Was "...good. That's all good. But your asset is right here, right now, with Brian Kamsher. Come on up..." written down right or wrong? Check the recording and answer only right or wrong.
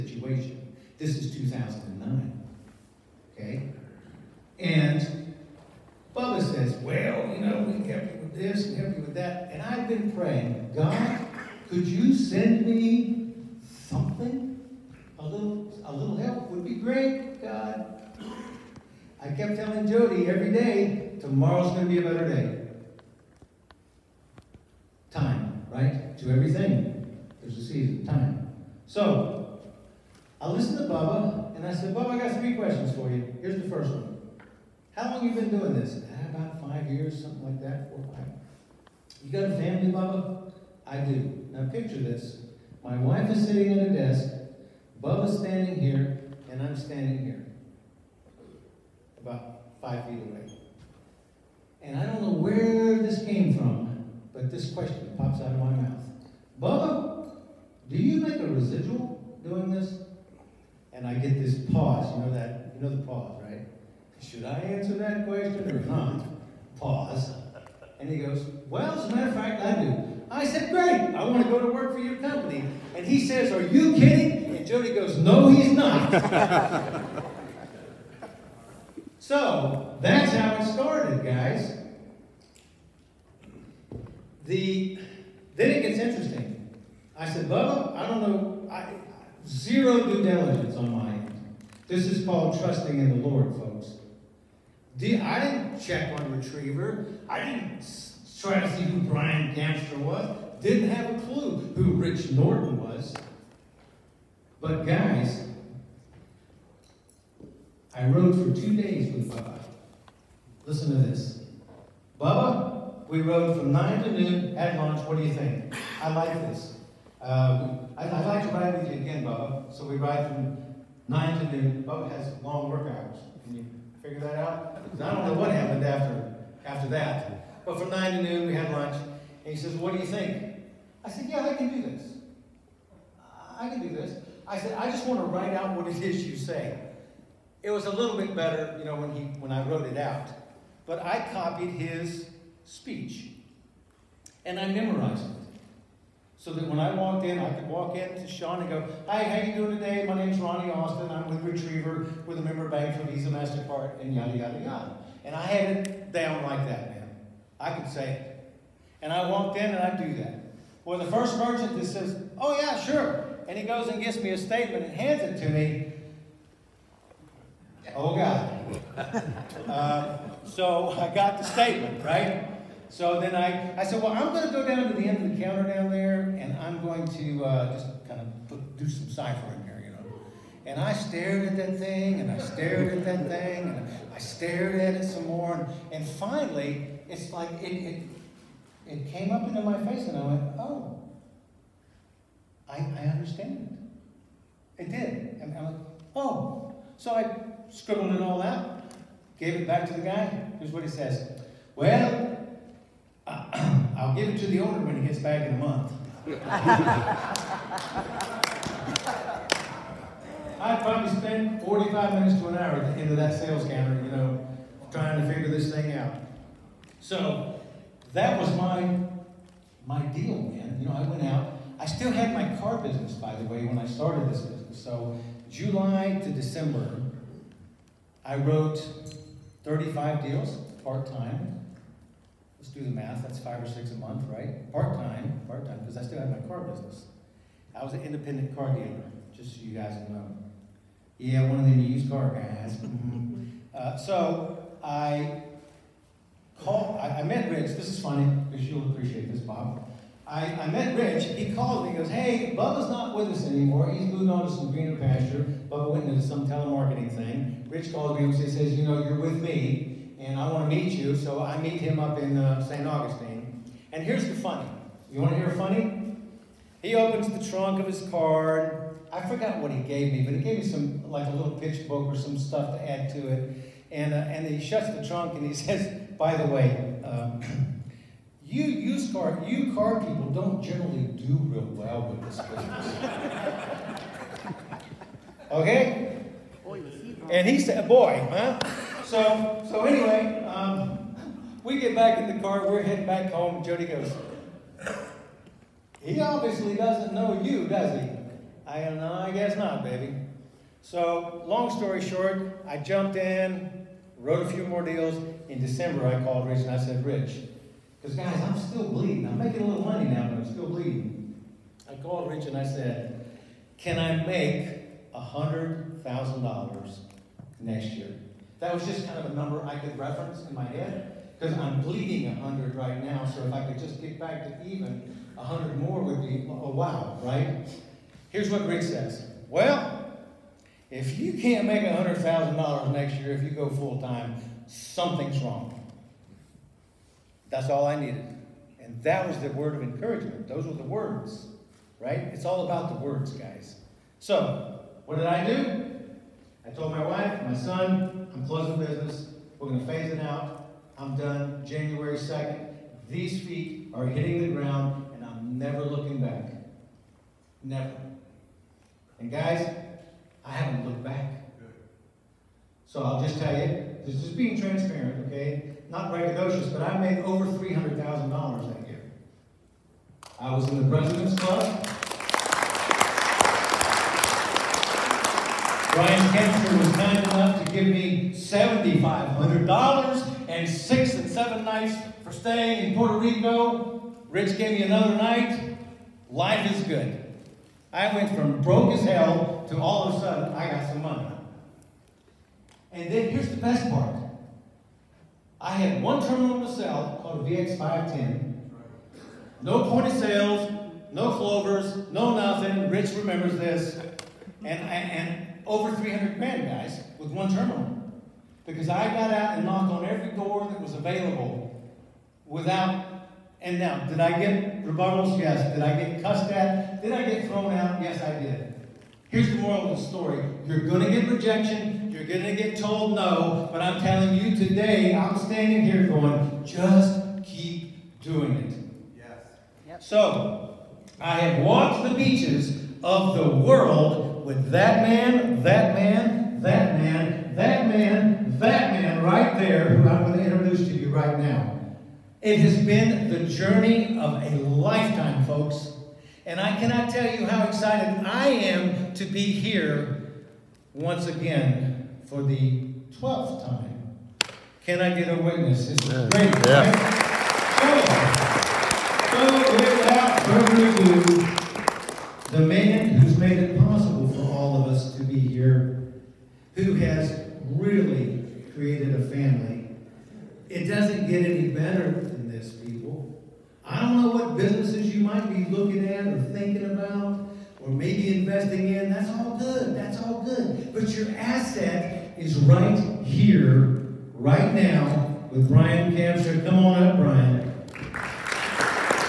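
right.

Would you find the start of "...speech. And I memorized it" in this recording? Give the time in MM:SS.
02:22.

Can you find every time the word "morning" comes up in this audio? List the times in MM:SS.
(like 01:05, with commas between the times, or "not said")
not said.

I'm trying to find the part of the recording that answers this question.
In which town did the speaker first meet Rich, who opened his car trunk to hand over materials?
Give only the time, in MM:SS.
04:22.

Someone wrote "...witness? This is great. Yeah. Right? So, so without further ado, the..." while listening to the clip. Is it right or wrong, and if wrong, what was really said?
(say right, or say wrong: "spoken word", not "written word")
right.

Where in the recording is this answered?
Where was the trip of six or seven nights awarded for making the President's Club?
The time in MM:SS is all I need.
06:22.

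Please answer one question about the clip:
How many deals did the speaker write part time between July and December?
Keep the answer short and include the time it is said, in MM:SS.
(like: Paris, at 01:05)
35, at 03:49.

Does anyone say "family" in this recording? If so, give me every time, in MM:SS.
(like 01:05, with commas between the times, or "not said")
00:39, 07:49.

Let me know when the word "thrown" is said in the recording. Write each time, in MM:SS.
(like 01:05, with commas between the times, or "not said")
06:57.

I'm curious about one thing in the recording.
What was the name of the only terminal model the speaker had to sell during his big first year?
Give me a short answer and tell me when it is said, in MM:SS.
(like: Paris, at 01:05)
VX510, at 06:37.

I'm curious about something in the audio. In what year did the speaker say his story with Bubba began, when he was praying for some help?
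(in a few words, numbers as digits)
2009.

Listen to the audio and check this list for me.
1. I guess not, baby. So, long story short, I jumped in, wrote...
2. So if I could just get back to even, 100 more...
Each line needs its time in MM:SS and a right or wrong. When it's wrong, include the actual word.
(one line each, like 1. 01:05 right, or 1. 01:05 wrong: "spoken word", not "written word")
1. 04:59 right
2. 05:23 right.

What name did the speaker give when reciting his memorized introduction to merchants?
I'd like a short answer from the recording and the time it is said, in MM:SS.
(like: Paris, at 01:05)
Ronnie Austin, at 02:30.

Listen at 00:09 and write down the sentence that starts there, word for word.
And I've been praying, God, could you send me something?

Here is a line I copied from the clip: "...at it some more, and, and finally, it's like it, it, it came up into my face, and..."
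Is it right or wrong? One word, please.
right.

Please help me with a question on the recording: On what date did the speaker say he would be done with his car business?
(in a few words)
January 2nd.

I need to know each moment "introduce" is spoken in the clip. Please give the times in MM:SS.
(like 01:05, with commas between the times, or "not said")
07:20.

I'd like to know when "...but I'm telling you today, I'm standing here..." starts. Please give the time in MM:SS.
07:03.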